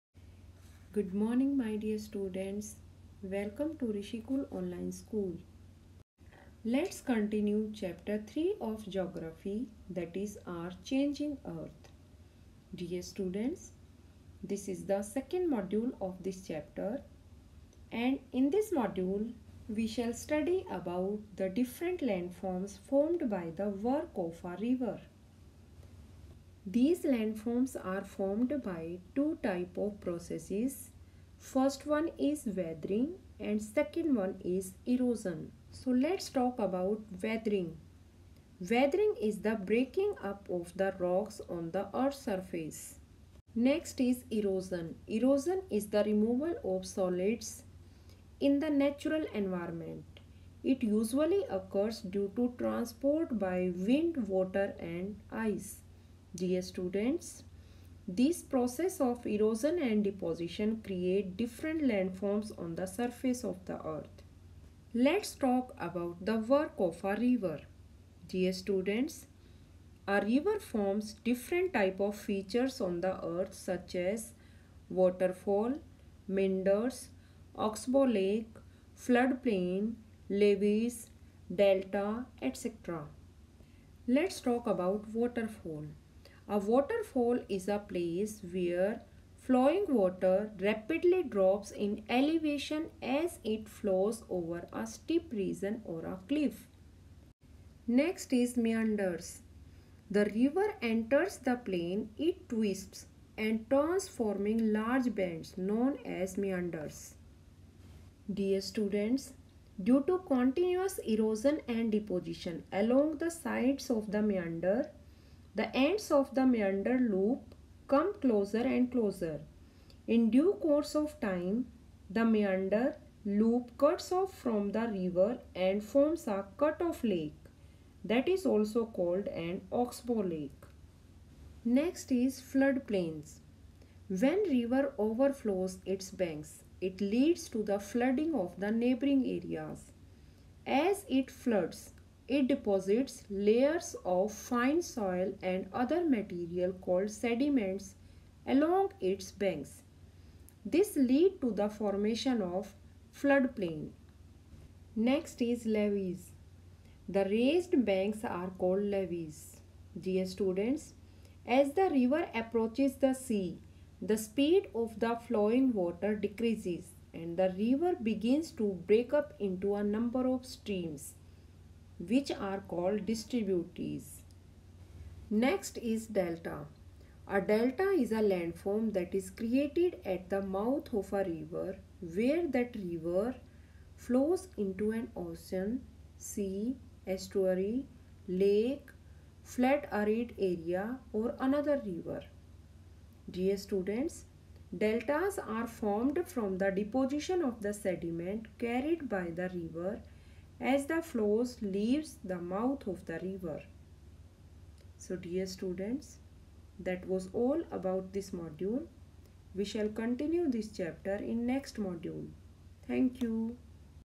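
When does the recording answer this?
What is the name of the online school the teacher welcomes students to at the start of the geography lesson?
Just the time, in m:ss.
0:03.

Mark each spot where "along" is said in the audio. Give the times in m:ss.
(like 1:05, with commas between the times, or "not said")
1:52, 2:28.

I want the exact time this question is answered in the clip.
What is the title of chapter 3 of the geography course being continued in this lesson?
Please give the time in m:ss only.
0:10.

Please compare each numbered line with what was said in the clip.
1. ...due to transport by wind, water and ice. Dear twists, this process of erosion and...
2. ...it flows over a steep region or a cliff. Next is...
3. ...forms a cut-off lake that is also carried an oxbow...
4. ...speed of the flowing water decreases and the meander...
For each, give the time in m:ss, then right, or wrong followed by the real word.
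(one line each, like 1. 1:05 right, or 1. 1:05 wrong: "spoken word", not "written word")
1. 0:52 wrong: "students", not "twists"
2. 1:33 right
3. 2:05 wrong: "called", not "carried"
4. 2:44 wrong: "river", not "meander".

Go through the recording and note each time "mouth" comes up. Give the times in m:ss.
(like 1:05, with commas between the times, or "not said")
3:00, 3:22.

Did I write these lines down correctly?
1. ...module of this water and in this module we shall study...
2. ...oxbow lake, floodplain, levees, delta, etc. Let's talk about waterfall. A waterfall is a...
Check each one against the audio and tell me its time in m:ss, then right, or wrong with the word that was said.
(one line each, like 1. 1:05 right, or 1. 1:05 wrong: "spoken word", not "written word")
1. 0:15 wrong: "chapter", not "water"
2. 1:17 right.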